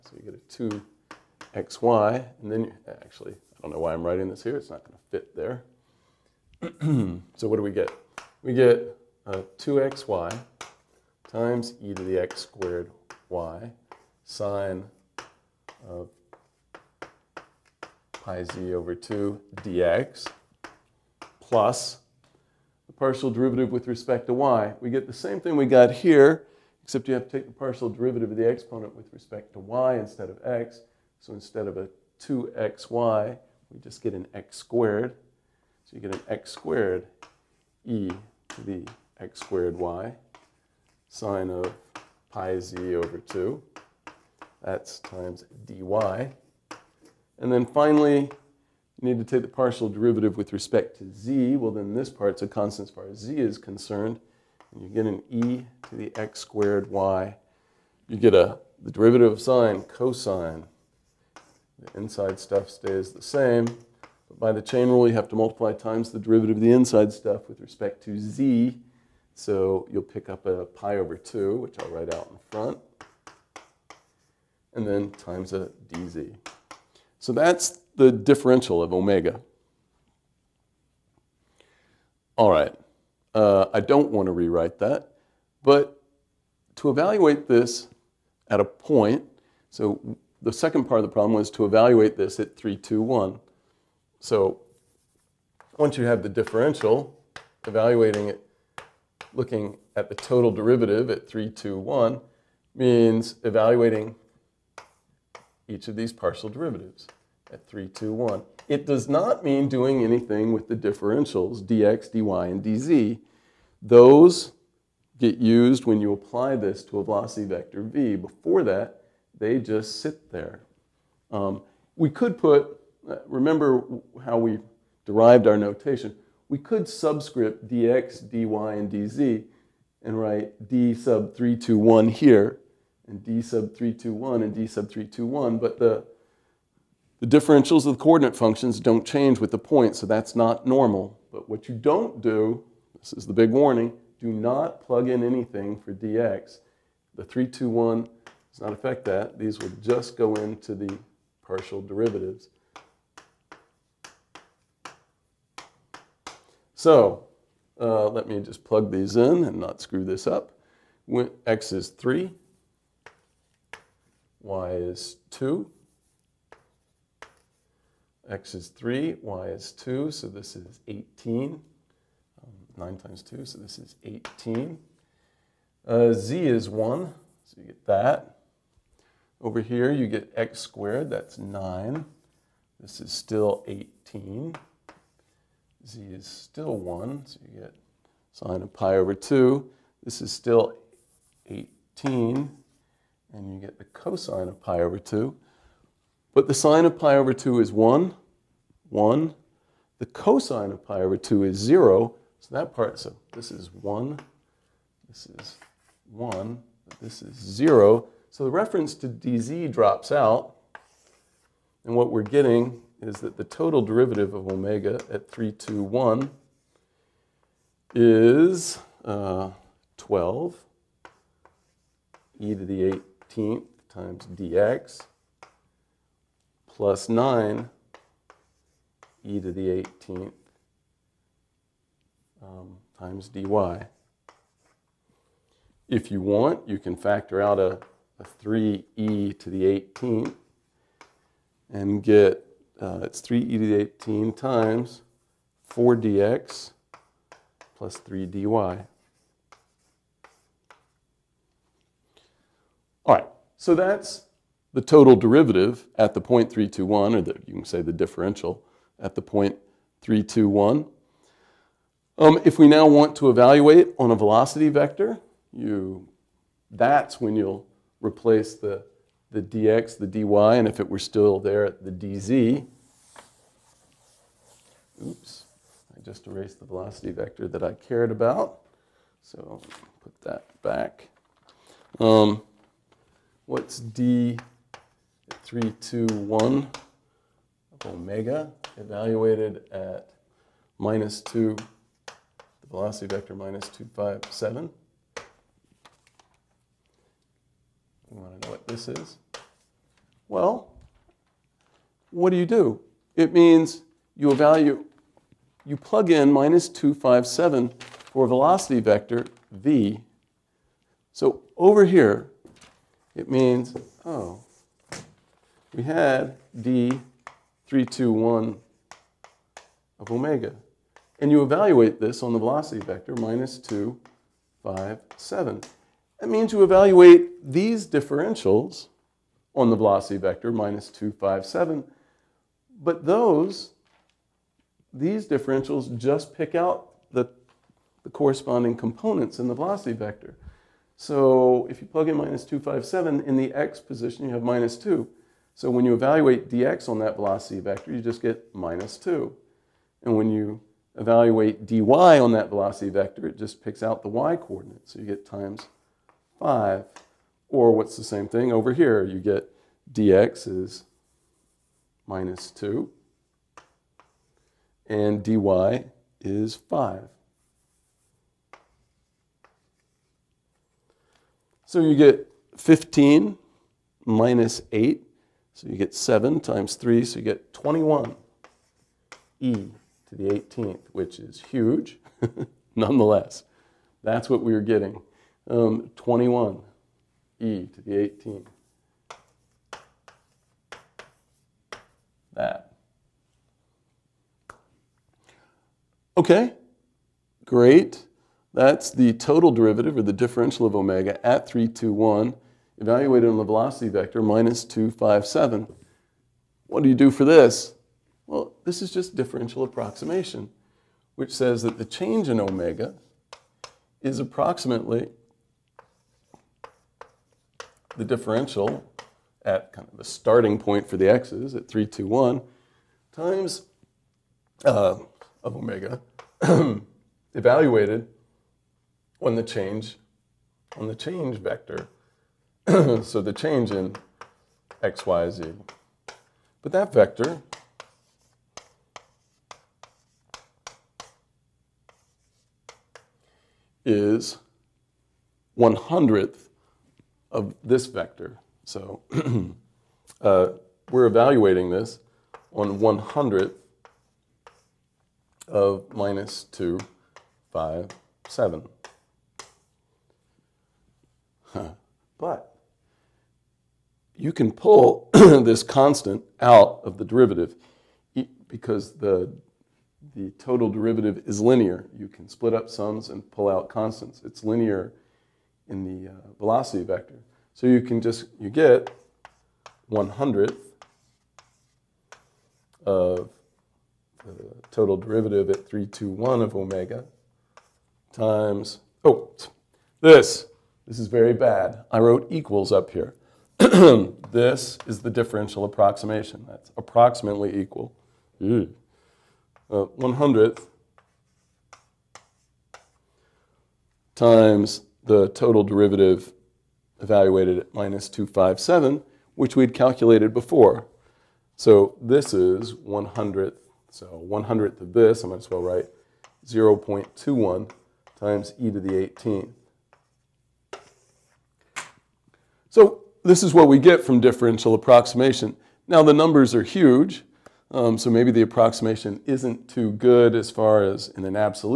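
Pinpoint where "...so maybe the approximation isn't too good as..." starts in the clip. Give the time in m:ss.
8:47.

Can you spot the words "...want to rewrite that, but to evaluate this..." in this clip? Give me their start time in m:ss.
1:24.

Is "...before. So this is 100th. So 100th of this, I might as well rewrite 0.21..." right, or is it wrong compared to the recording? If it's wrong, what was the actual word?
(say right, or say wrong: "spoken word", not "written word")
wrong: "write", not "rewrite".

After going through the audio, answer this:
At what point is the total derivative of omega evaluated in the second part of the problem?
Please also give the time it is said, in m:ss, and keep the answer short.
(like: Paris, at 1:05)
3, 2, 1, at 1:32.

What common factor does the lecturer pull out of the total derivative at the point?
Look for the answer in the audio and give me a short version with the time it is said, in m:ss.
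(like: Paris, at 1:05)
3e to the 18th, at 3:58.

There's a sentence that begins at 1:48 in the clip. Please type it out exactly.
It does not mean doing anything with the differentials, dx, dy, and dz.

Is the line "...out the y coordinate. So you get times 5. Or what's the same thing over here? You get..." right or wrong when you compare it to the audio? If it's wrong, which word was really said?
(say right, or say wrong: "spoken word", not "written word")
right.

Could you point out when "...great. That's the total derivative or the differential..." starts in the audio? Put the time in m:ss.
6:37.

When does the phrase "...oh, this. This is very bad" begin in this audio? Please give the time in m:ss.
8:09.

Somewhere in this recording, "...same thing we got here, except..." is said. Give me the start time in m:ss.
0:25.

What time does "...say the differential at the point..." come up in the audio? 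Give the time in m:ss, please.
4:17.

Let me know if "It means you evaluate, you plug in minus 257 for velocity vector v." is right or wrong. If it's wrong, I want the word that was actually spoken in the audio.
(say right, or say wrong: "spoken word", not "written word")
right.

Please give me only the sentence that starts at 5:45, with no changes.
So when you evaluate dx on that velocity vector, you just get minus 2.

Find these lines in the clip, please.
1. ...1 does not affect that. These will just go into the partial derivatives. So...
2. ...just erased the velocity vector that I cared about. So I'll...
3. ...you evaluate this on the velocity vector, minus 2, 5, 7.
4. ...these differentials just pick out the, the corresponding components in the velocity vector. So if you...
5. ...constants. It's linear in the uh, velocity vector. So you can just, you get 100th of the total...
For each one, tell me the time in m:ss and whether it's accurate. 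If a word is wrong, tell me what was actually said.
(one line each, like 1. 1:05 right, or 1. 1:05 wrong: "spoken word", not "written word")
1. 2:27 right
2. 4:36 right
3. 5:21 right
4. 5:34 right
5. 7:53 right.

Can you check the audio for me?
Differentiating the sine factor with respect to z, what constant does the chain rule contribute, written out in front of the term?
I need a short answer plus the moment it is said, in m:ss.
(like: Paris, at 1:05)
pi over 2, at 1:09.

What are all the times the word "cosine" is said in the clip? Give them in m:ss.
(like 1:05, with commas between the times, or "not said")
0:59, 3:13, 3:20.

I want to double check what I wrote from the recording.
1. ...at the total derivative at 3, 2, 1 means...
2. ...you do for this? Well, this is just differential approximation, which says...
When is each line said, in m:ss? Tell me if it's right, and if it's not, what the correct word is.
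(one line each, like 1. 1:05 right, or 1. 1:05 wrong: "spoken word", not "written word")
1. 1:39 right
2. 6:46 right.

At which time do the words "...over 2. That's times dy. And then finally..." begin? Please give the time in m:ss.
0:42.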